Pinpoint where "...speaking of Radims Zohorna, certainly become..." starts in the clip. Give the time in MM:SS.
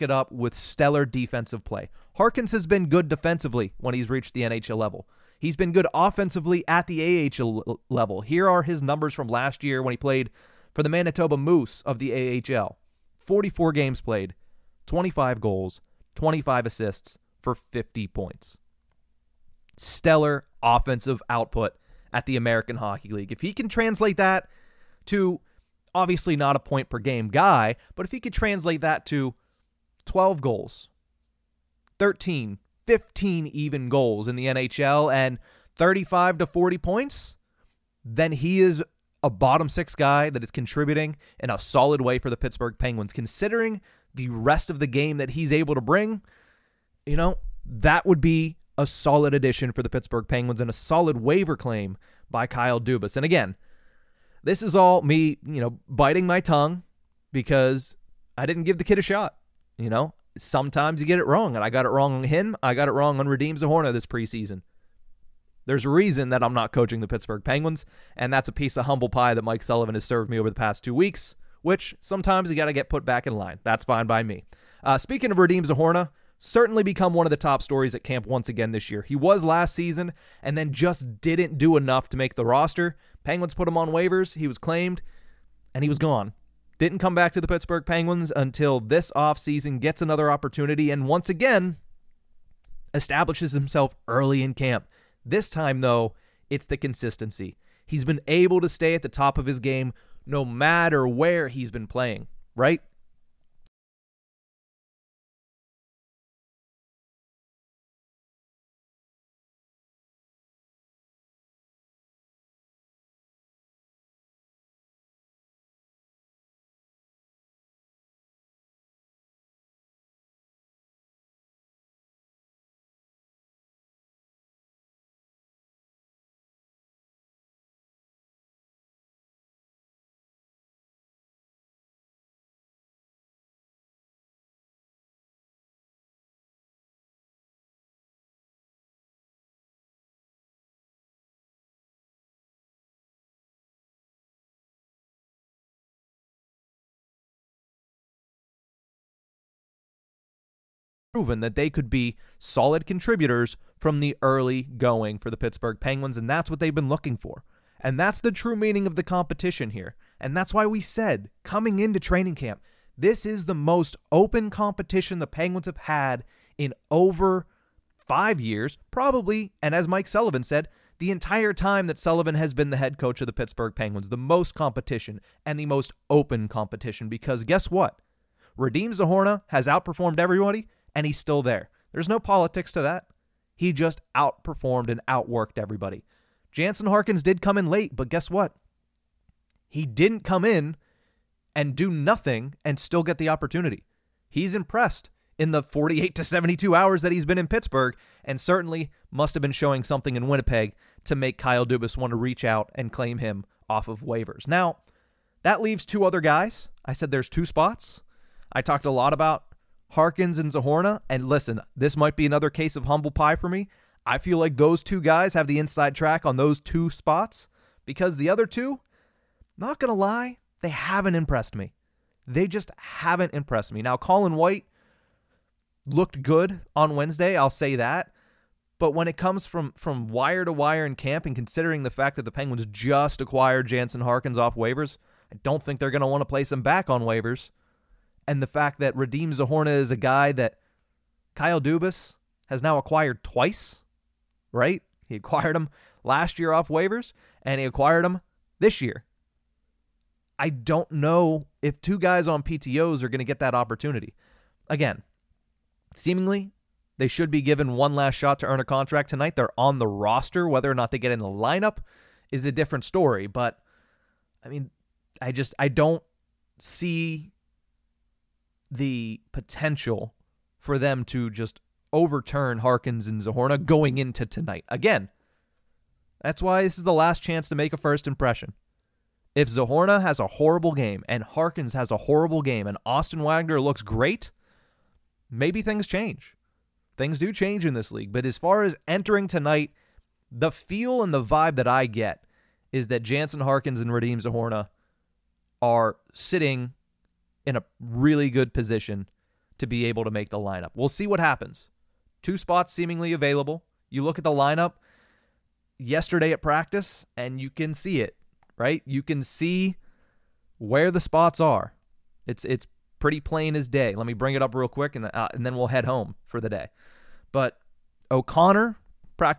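01:14.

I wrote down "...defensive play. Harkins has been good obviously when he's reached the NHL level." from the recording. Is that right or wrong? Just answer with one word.
wrong.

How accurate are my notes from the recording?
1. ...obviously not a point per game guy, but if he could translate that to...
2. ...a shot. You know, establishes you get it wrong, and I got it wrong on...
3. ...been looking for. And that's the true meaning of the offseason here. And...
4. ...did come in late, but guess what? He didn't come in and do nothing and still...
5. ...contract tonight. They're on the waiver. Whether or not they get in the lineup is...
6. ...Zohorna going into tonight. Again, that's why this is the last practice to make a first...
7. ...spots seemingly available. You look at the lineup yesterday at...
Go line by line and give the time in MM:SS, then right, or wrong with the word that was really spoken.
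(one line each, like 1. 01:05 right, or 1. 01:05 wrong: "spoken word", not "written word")
1. 00:25 right
2. 00:58 wrong: "sometimes", not "establishes"
3. 02:36 wrong: "competition", not "offseason"
4. 03:07 right
5. 04:18 wrong: "roster", not "waiver"
6. 04:33 wrong: "chance", not "practice"
7. 05:02 right.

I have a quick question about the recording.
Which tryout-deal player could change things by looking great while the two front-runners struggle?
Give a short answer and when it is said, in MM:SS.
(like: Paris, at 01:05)
Austin Wagner, at 04:42.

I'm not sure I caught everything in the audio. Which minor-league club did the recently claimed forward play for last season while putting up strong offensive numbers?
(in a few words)
Manitoba Moose.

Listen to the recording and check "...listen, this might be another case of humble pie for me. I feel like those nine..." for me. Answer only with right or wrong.
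wrong.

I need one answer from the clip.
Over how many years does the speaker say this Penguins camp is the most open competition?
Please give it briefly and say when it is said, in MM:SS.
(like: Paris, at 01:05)
5, at 02:48.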